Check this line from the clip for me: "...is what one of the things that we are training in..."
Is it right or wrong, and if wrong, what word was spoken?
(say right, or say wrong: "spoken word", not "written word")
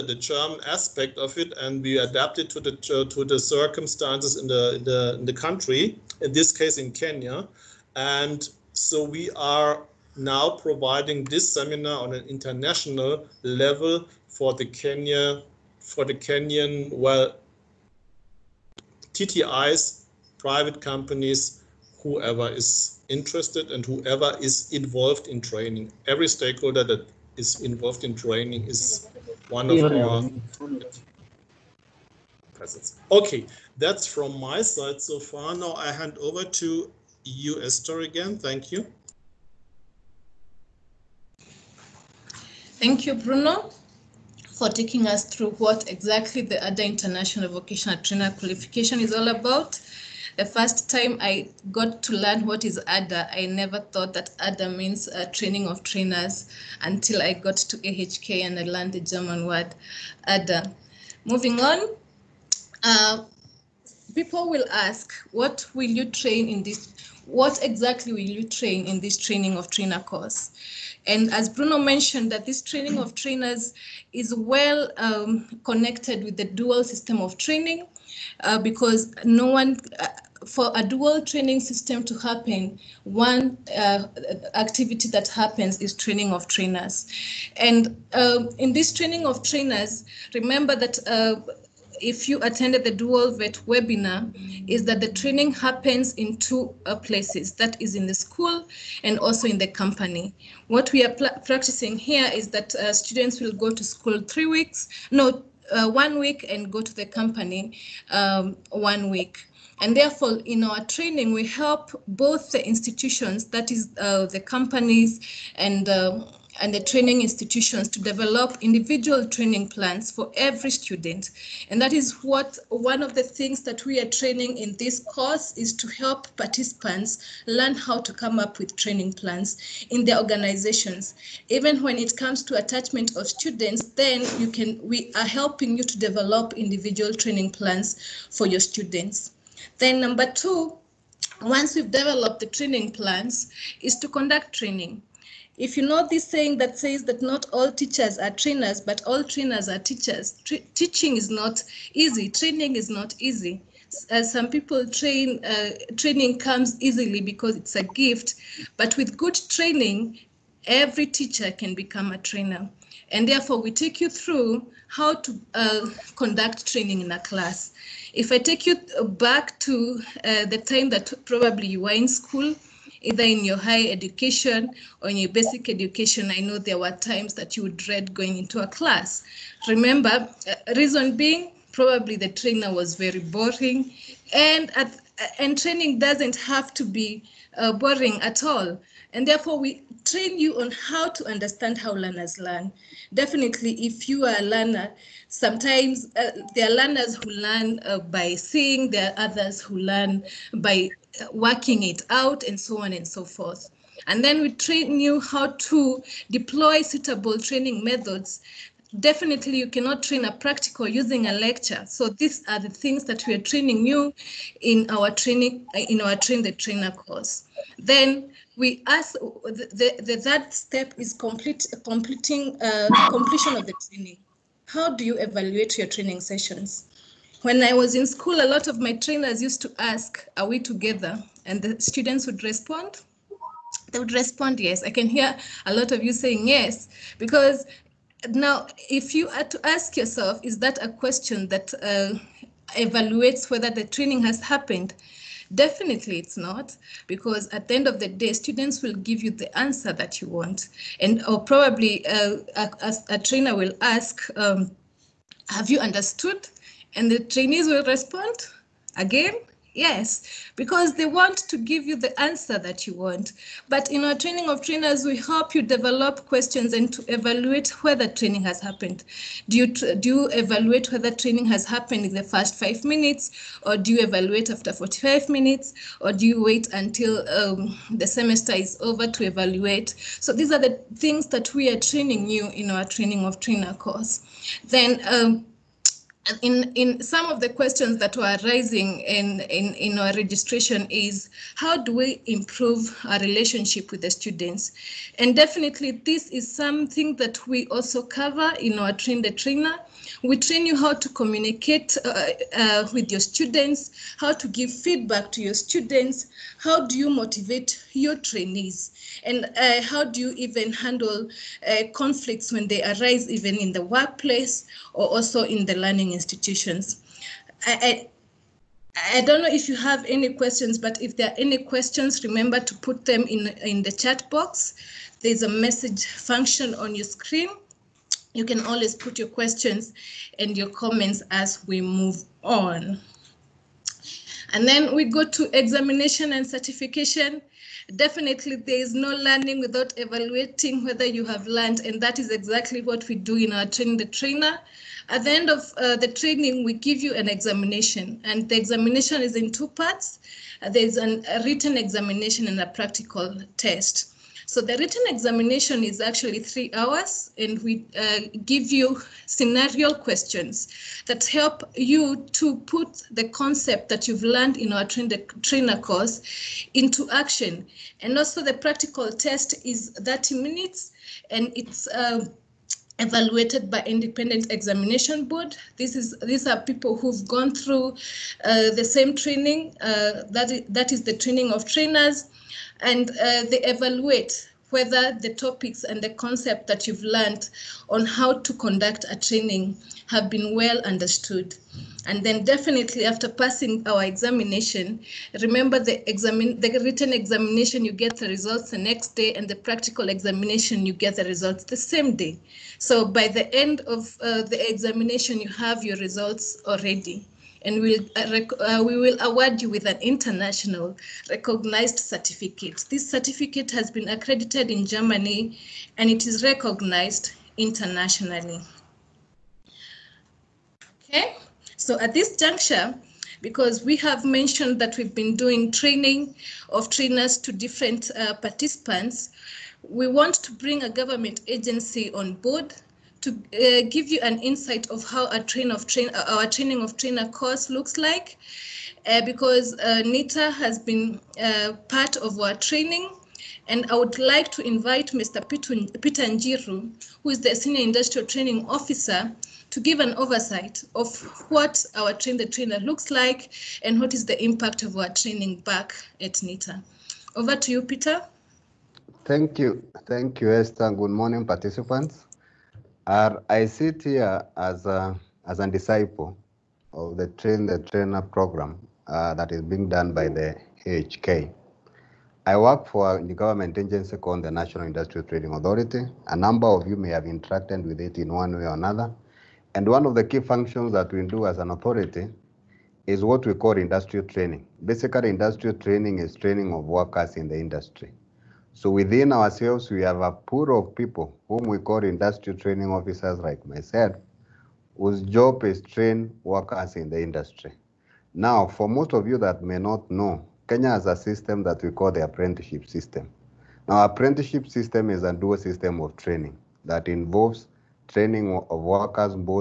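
right.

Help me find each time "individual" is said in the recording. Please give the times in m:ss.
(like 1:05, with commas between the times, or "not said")
1:58, 2:16.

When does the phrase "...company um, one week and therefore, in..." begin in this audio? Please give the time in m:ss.
1:47.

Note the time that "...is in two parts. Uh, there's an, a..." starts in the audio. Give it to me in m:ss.
5:49.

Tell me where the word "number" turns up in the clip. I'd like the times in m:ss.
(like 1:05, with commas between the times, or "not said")
2:20, 7:56.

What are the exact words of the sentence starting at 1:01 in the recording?
Moving on, uh, people will ask, what will you train in this?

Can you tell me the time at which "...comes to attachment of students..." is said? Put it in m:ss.
2:12.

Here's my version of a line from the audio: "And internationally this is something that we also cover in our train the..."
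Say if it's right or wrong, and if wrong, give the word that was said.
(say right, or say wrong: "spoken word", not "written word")
wrong: "definitely", not "internationally".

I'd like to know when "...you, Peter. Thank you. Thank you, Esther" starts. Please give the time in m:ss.
7:37.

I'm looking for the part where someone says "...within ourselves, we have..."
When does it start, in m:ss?
8:08.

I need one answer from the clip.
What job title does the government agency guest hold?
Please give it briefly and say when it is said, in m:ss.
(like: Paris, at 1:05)
Senior Industrial Training Officer, at 7:27.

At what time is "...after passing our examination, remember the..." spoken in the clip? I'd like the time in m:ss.
6:33.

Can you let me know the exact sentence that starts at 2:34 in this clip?
Uh, some people train, uh, training comes easily because it's a gift, but with good training, every teacher can become a trainer.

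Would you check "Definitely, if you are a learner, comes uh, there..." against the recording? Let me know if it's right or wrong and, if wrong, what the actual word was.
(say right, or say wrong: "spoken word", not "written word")
wrong: "sometimes", not "comes".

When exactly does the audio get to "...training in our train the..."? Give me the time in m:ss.
3:35.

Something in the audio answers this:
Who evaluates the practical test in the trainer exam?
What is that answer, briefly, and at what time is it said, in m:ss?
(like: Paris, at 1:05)
independent examination board, at 6:13.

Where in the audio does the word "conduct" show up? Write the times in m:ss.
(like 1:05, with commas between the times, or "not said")
2:24, 2:46, 6:28.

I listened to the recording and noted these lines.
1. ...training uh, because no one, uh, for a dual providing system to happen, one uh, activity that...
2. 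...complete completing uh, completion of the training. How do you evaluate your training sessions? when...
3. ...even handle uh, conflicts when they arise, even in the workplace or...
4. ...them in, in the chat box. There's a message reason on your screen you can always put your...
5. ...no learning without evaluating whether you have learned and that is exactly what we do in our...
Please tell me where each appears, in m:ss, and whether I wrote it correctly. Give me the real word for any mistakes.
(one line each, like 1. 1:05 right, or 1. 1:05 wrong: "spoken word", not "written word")
1. 1:17 wrong: "training", not "providing"
2. 3:41 right
3. 5:10 right
4. 5:23 wrong: "function", not "reason"
5. 5:38 right.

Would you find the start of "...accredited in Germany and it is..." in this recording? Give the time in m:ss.
6:54.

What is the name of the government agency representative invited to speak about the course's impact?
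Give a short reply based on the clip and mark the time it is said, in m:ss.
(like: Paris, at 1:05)
Peter Njiru, at 7:25.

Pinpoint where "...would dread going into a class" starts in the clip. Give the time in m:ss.
2:57.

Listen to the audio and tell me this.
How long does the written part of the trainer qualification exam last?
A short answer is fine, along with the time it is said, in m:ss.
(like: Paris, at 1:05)
3 hours, at 5:56.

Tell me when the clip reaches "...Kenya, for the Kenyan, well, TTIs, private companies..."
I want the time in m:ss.
0:14.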